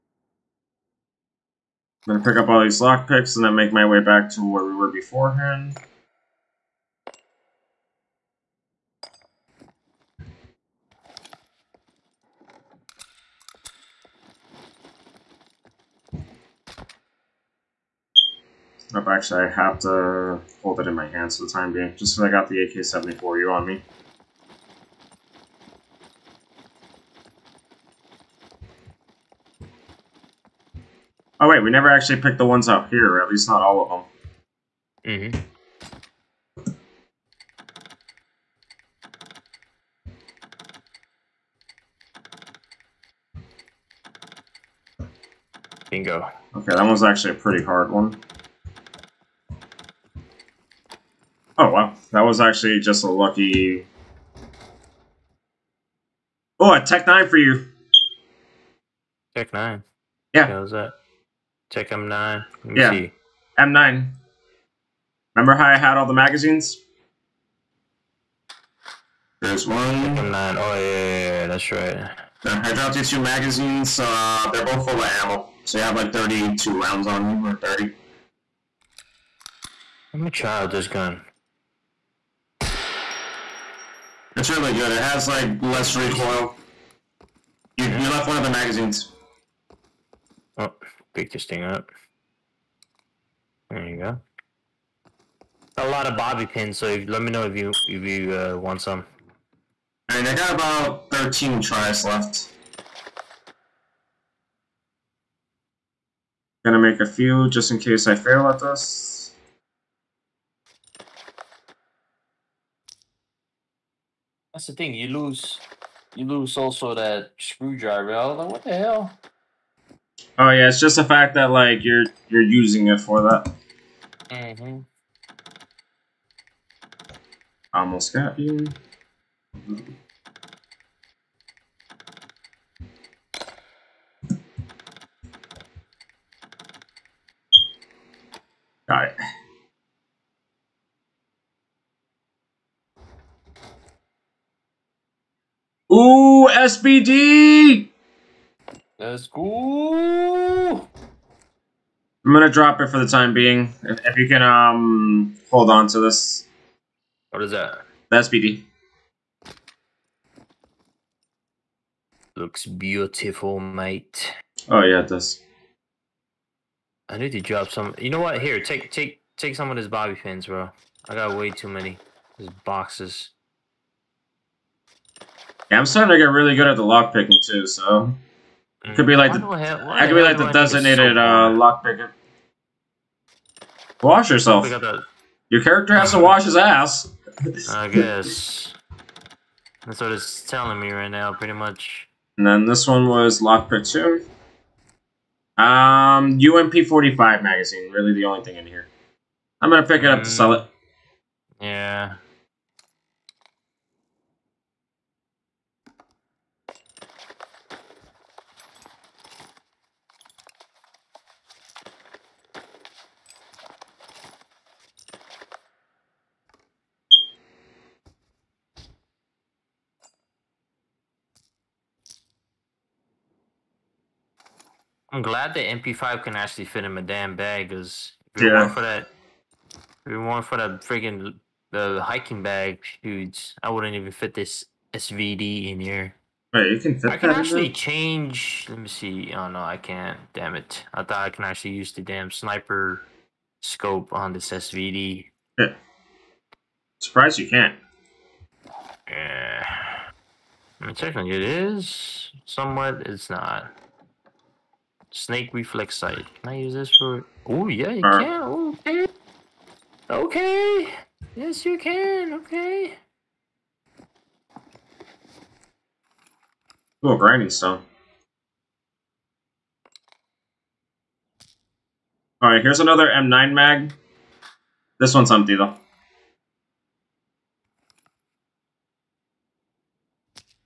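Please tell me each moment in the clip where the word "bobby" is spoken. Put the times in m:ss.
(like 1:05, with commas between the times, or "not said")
1:36, 2:49.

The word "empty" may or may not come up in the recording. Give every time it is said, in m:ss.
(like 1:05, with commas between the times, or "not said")
4:35.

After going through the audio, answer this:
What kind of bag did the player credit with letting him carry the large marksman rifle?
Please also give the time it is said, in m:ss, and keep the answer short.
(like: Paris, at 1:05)
hiking bag, at 3:52.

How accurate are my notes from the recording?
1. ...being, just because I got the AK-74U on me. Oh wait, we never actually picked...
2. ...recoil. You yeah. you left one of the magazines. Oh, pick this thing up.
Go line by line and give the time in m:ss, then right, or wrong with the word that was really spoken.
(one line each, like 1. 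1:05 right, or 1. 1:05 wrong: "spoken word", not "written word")
1. 0:21 right
2. 1:25 right.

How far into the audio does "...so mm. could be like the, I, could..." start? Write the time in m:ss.
2:57.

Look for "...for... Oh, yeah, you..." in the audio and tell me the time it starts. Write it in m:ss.
4:16.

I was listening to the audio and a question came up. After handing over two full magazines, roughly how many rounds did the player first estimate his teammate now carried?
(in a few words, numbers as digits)
32.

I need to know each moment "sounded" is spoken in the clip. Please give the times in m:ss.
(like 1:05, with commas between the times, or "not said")
not said.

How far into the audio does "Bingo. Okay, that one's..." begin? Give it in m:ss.
0:45.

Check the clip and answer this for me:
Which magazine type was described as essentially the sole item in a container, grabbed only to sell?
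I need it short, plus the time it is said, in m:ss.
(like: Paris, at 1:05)
UMP 45 magazine, at 3:16.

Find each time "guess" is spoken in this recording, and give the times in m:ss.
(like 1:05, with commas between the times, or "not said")
3:07.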